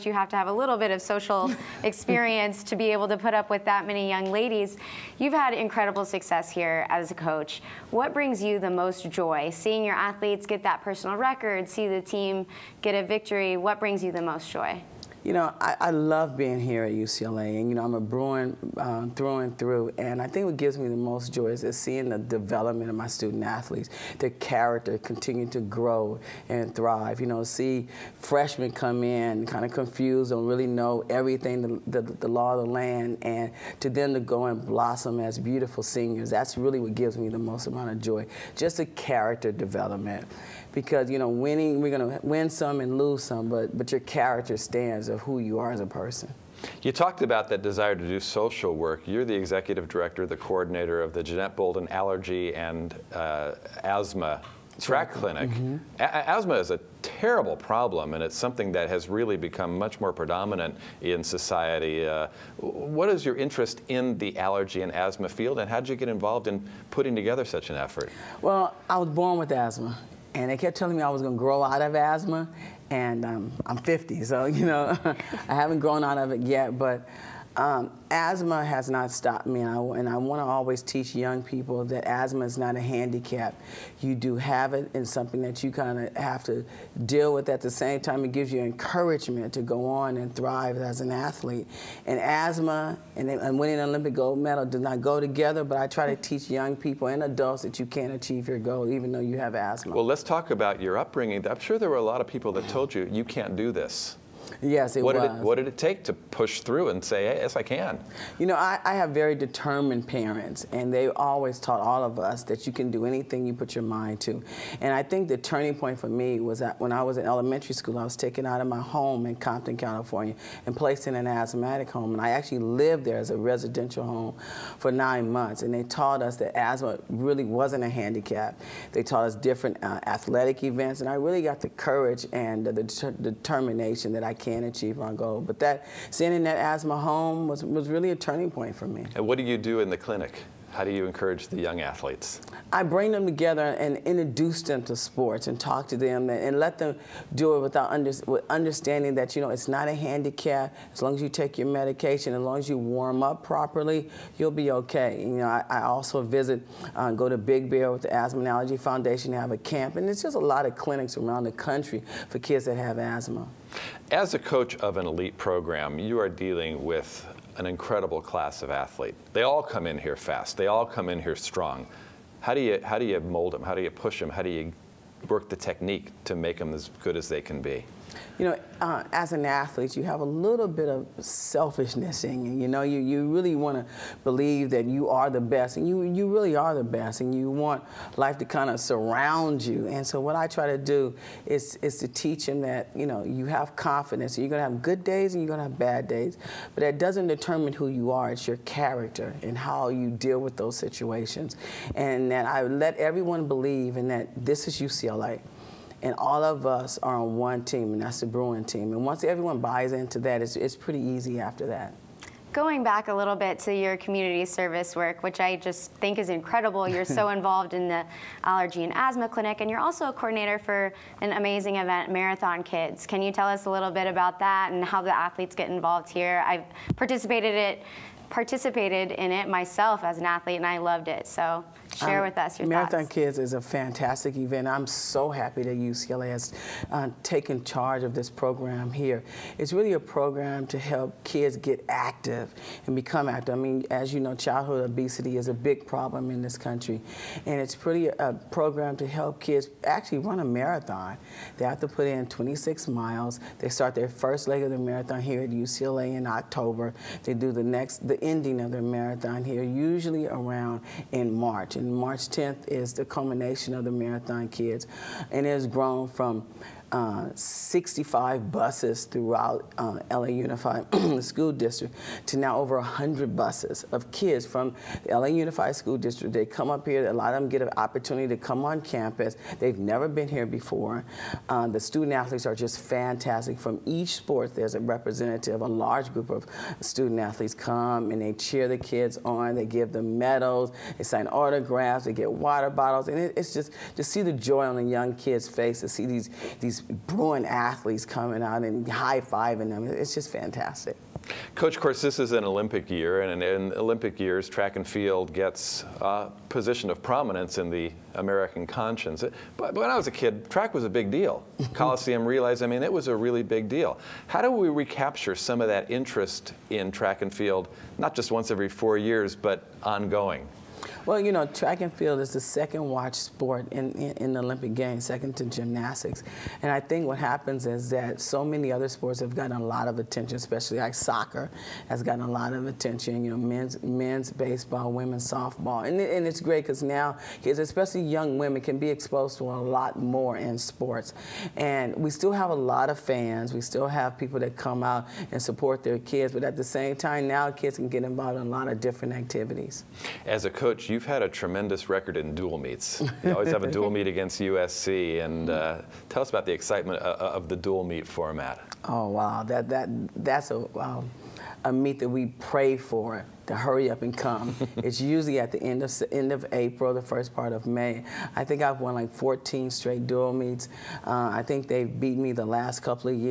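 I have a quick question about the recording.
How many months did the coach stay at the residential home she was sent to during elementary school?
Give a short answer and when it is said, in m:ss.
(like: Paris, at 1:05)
9, at 2:04.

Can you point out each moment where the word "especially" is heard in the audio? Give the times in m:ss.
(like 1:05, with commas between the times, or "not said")
5:30, 5:37.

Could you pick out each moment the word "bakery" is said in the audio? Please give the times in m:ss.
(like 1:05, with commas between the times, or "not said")
not said.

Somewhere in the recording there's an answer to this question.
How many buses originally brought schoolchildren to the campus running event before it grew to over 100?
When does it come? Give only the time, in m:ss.
4:27.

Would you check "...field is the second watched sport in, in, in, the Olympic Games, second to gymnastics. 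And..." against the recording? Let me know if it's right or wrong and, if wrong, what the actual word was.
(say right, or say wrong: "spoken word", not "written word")
right.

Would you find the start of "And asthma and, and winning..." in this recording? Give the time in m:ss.
1:32.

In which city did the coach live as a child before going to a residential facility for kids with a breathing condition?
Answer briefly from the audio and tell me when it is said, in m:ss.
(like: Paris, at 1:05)
Compton, California, at 1:59.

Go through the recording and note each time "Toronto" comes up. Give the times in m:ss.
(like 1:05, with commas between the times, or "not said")
not said.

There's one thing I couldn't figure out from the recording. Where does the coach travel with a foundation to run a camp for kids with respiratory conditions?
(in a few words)
Big Bear.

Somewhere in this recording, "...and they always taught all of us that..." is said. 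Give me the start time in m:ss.
1:50.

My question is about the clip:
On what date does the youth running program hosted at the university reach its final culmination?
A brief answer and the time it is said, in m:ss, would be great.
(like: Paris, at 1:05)
March 10th, at 4:21.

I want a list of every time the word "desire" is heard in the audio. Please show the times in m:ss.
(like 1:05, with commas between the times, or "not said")
0:47.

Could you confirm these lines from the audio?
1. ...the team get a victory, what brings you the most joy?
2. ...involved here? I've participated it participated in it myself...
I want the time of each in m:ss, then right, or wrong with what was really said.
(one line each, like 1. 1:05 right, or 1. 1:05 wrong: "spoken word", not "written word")
1. 0:11 right
2. 3:45 right.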